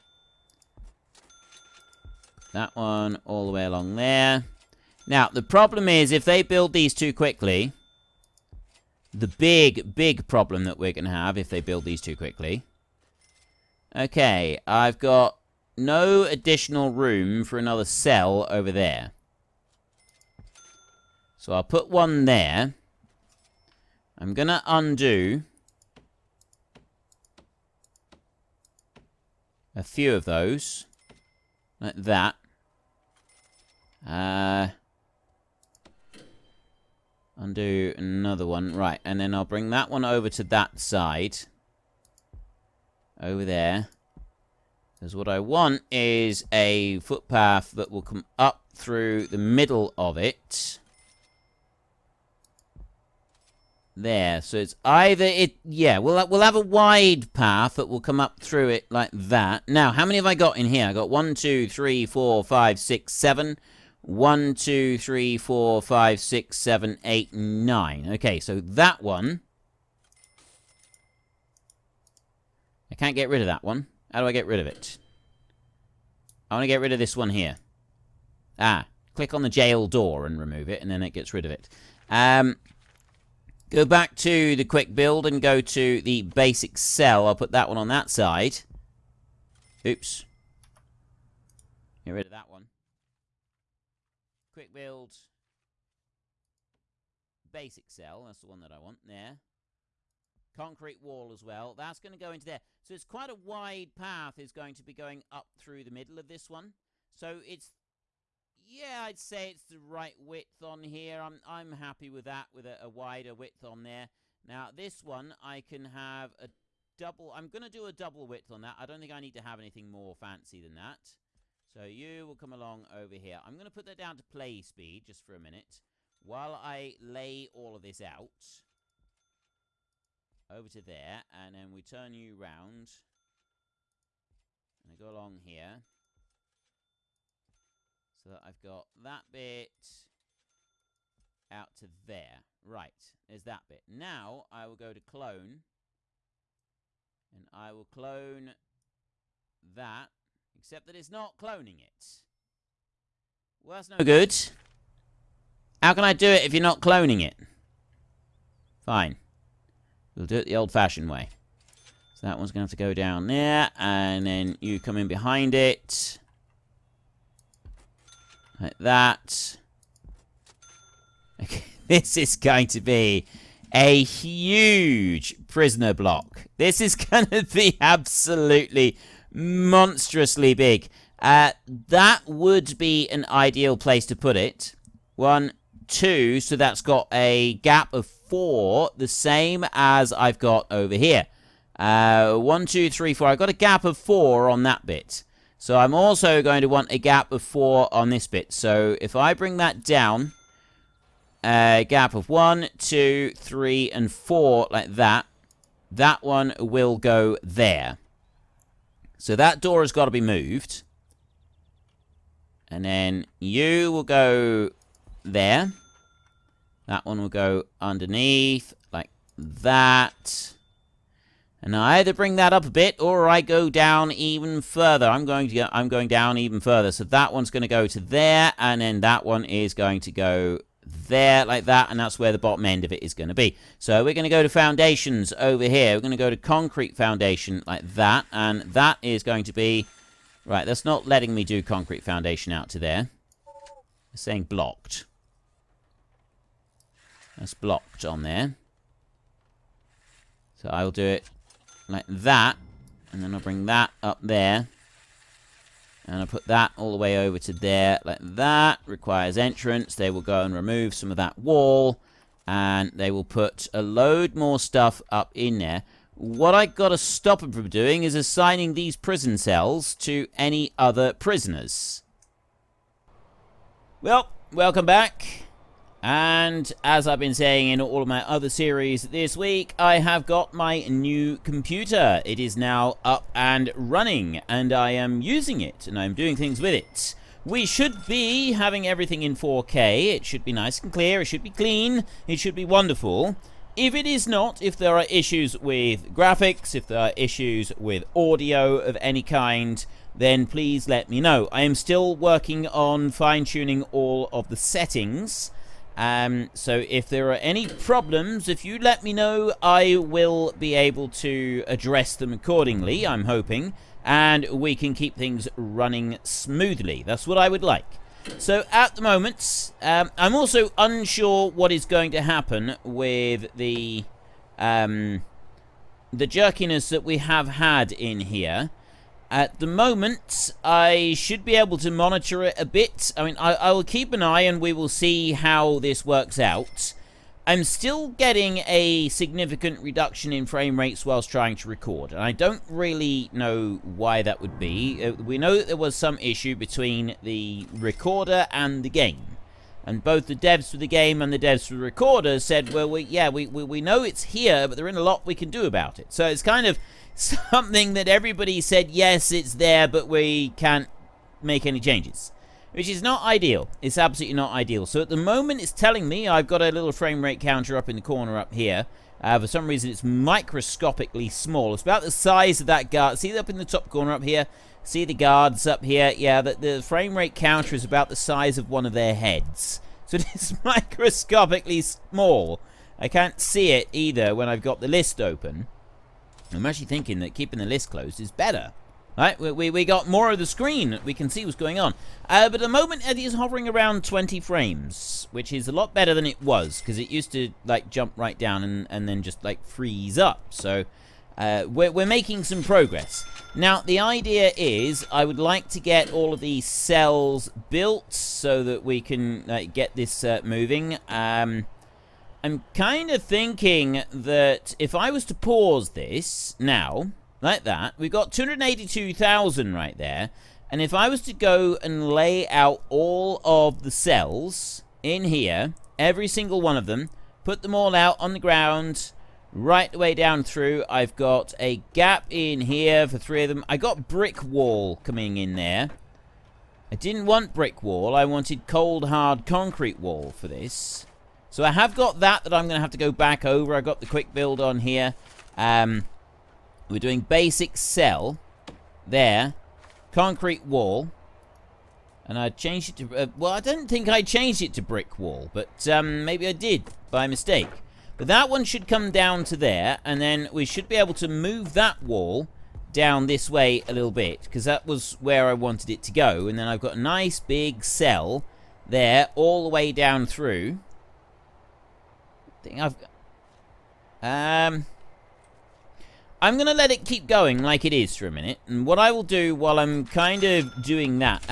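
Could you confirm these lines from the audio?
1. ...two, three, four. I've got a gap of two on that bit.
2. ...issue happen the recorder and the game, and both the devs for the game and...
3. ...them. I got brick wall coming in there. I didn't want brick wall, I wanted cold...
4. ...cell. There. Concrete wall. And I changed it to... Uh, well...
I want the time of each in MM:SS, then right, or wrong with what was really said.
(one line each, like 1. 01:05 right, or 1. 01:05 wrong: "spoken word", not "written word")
1. 03:12 wrong: "four", not "two"
2. 05:46 wrong: "between", not "happen"
3. 07:13 right
4. 07:27 right.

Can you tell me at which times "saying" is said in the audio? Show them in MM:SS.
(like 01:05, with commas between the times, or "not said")
04:04, 04:37.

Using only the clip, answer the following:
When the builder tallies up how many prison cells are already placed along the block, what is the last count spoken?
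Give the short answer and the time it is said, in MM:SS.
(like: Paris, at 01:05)
9, at 01:01.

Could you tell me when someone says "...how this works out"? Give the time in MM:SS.
05:35.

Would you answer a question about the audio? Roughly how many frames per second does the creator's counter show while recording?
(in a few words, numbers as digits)
20.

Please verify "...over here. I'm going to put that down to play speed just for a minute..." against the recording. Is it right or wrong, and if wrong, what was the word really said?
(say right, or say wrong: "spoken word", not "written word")
right.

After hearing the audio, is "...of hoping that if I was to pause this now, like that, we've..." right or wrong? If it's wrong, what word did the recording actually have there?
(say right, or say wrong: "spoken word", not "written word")
wrong: "thinking", not "hoping".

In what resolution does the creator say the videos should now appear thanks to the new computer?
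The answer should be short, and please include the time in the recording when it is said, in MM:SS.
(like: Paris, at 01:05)
4K, at 04:49.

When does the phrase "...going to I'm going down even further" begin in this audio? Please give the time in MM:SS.
03:45.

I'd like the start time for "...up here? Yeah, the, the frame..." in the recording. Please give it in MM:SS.
06:15.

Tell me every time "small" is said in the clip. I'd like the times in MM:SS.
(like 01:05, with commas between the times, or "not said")
06:11, 06:21.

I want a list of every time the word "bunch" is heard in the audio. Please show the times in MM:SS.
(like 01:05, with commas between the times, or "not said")
not said.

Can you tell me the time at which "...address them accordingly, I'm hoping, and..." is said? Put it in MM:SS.
05:11.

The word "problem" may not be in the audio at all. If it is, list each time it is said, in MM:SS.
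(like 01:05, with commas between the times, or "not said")
00:05, 00:10, 05:07.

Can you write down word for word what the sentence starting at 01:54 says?
Now, this one, I can have a double, I'm going to do a double width on that.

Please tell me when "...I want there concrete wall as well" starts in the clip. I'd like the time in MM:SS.
01:38.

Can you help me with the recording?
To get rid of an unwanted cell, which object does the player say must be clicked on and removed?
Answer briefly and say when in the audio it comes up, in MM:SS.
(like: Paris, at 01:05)
the jail door, at 01:19.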